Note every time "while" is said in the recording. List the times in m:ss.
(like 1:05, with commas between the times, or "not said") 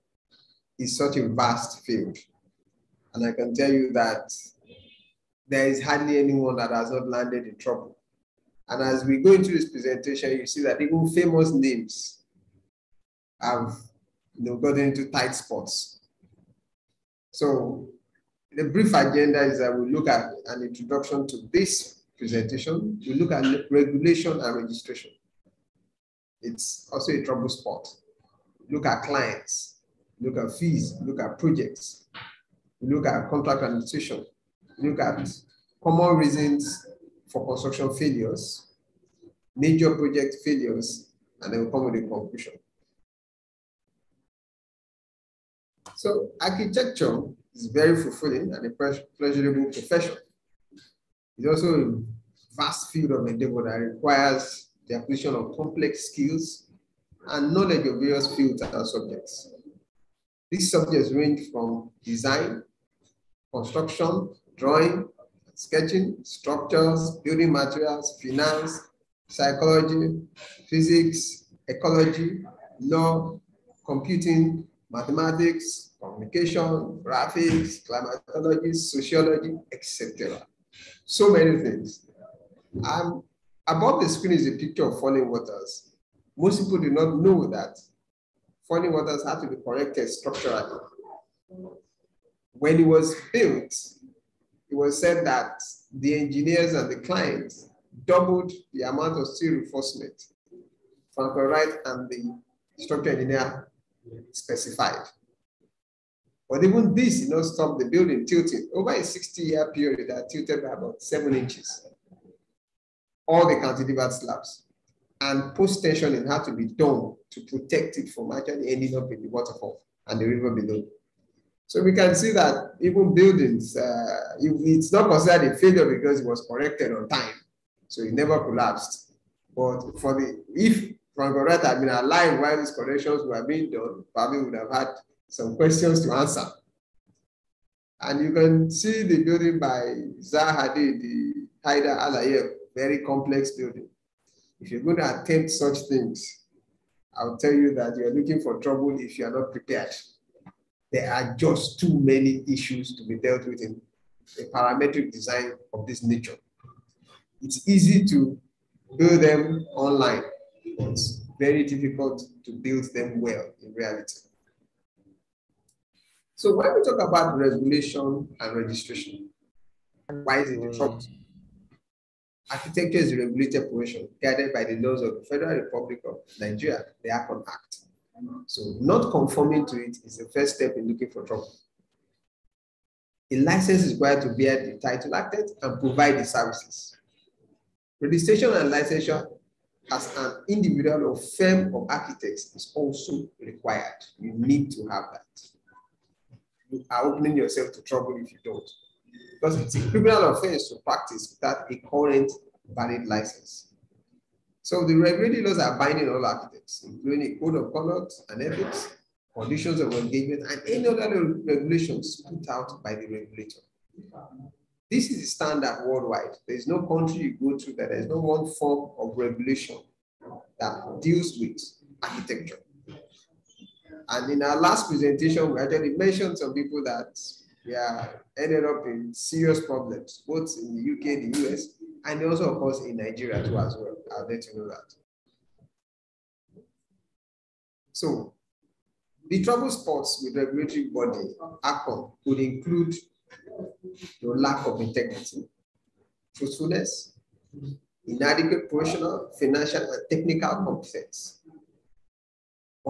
2:12.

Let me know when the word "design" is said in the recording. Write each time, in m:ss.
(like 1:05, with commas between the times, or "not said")
1:02, 2:35.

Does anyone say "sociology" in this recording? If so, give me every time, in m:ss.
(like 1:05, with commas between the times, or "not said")
1:18.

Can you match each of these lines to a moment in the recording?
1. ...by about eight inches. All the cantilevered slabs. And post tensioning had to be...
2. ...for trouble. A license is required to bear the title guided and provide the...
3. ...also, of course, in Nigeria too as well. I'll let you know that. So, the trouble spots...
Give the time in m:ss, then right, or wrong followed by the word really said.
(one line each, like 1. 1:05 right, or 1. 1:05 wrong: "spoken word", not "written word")
1. 1:50 wrong: "seven", not "eight"
2. 3:01 wrong: "acted", not "guided"
3. 3:52 right.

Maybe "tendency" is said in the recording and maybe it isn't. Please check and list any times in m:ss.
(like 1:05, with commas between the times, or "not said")
not said.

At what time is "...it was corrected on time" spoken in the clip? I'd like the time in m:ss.
2:06.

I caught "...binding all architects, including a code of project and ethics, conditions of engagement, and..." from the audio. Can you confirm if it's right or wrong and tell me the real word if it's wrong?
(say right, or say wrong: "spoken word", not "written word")
wrong: "conduct", not "project".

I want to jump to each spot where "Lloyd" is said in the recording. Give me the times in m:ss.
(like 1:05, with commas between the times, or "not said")
1:41, 2:11.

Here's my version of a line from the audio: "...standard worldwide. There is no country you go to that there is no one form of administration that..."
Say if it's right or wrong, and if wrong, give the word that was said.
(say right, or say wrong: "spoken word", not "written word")
wrong: "regulation", not "administration".